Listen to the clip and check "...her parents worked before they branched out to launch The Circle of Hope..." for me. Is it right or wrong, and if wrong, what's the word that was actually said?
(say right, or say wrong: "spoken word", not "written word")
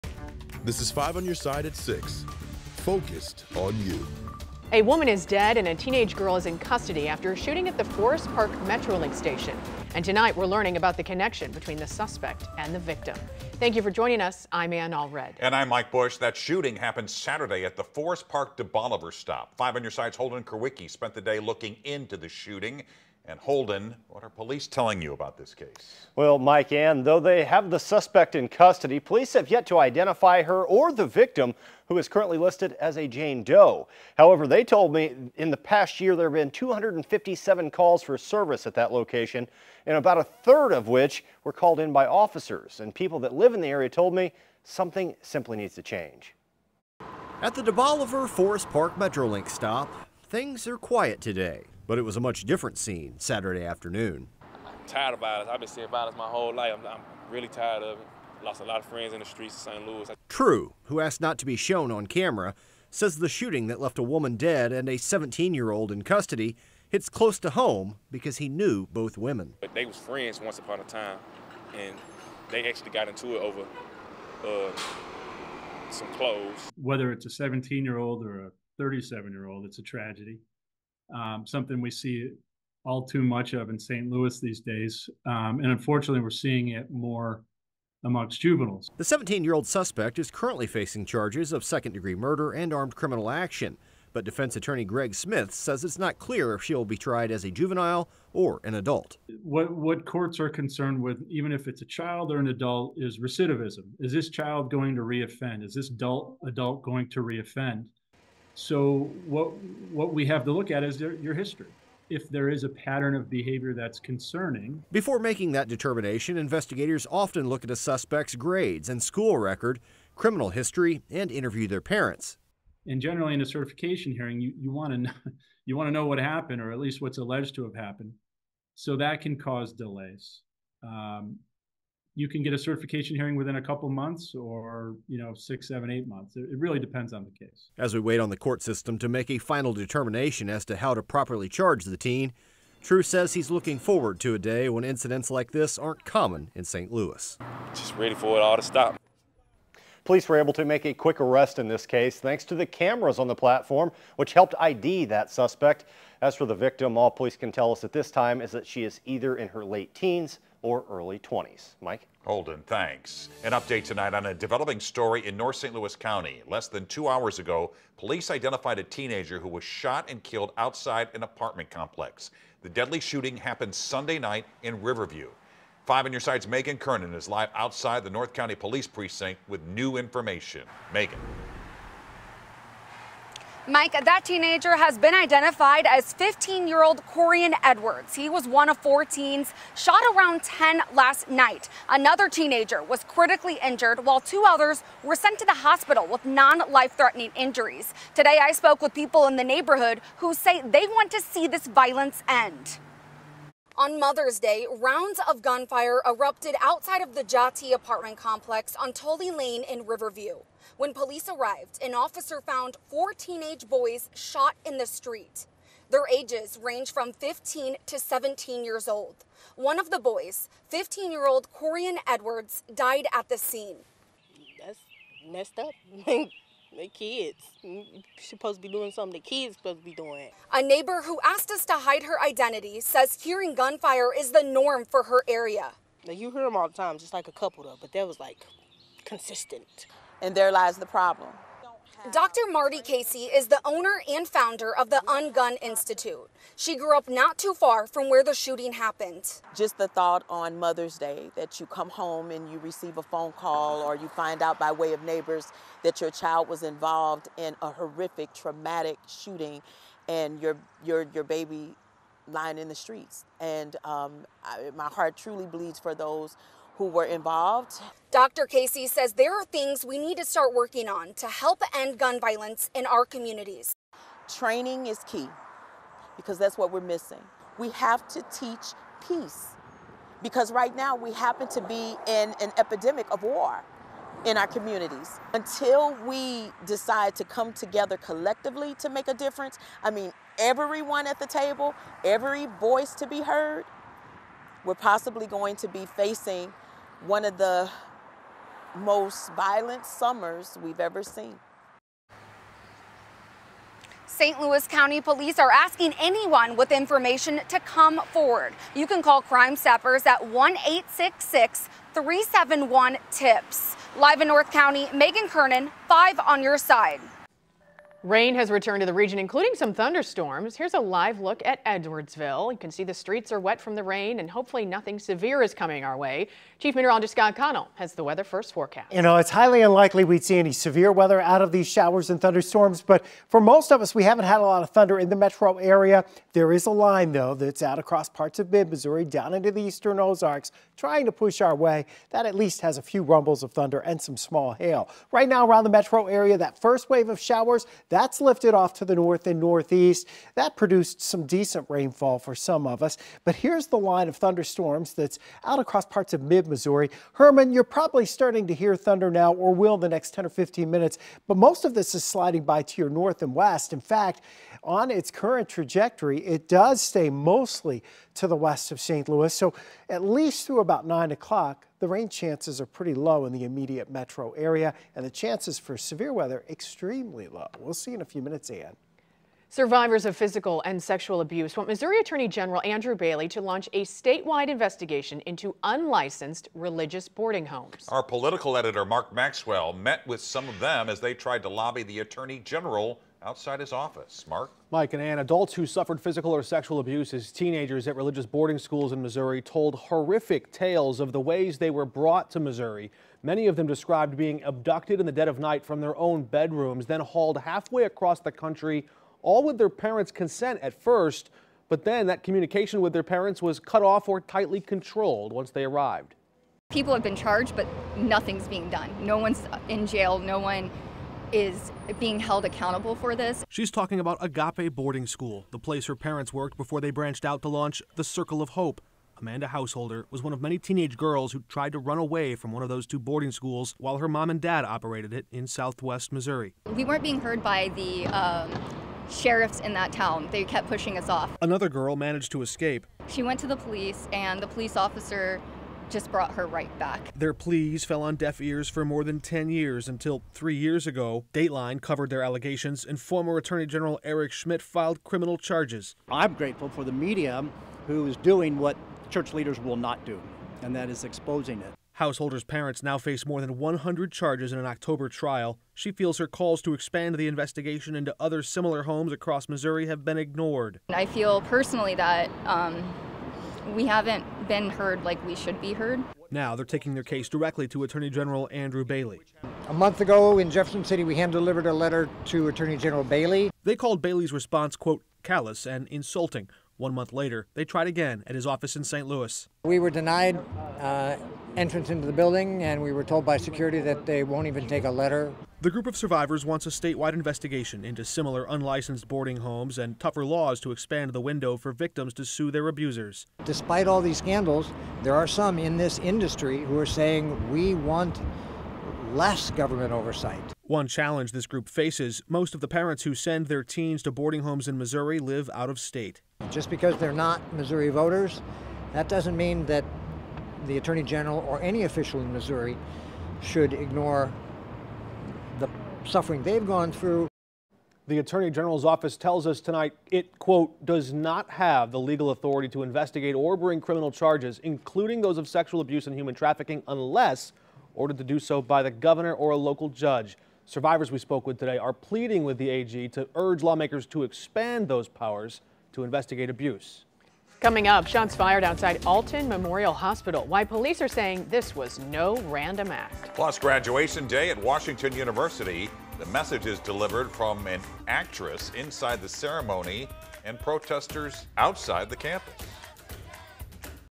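right.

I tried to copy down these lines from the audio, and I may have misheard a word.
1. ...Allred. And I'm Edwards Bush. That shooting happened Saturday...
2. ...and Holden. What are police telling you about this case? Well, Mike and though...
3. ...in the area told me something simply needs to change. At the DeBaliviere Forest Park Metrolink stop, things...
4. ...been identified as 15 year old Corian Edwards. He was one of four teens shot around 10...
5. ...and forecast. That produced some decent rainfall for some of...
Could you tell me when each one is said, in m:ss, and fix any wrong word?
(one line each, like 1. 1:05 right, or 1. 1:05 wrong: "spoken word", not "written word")
1. 0:14 wrong: "Mike", not "Edwards"
2. 0:23 right
3. 0:43 right
4. 3:04 right
5. 5:49 wrong: "northeast", not "forecast".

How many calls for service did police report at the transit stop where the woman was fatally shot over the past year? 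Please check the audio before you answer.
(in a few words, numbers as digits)
257.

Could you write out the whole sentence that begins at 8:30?
One challenge this group faces most of the parents who send their teens to boarding homes in Missouri live out of state.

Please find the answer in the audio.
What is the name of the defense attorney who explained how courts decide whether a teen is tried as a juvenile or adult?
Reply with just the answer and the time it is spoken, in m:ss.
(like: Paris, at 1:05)
Greg Smith, at 1:34.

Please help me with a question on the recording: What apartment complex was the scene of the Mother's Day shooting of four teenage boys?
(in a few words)
Jati.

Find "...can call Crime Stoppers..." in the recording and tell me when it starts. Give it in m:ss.
5:08.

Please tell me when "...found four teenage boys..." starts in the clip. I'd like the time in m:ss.
3:32.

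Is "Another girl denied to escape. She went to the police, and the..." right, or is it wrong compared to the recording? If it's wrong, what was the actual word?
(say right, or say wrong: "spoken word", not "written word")
wrong: "managed", not "denied".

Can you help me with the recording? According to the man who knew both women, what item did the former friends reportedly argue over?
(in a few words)
clothes.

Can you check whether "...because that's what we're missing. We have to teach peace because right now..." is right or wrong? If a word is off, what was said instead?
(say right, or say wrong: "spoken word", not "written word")
right.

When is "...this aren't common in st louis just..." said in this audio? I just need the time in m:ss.
2:25.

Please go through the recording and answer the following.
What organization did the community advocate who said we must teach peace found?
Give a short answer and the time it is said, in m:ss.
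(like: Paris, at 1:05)
Ungun Institute, at 4:05.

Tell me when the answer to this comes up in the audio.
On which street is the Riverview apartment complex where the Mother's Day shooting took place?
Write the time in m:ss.
3:28.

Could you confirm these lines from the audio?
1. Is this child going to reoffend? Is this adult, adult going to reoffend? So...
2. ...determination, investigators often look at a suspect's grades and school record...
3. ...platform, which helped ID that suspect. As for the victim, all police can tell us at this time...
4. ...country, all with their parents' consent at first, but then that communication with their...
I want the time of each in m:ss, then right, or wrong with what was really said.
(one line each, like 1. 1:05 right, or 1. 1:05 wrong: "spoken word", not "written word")
1. 1:43 right
2. 1:55 right
3. 2:33 right
4. 6:48 right.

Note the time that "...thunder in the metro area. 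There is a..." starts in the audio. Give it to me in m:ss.
5:34.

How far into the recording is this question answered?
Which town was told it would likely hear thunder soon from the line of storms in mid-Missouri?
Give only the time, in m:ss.
5:57.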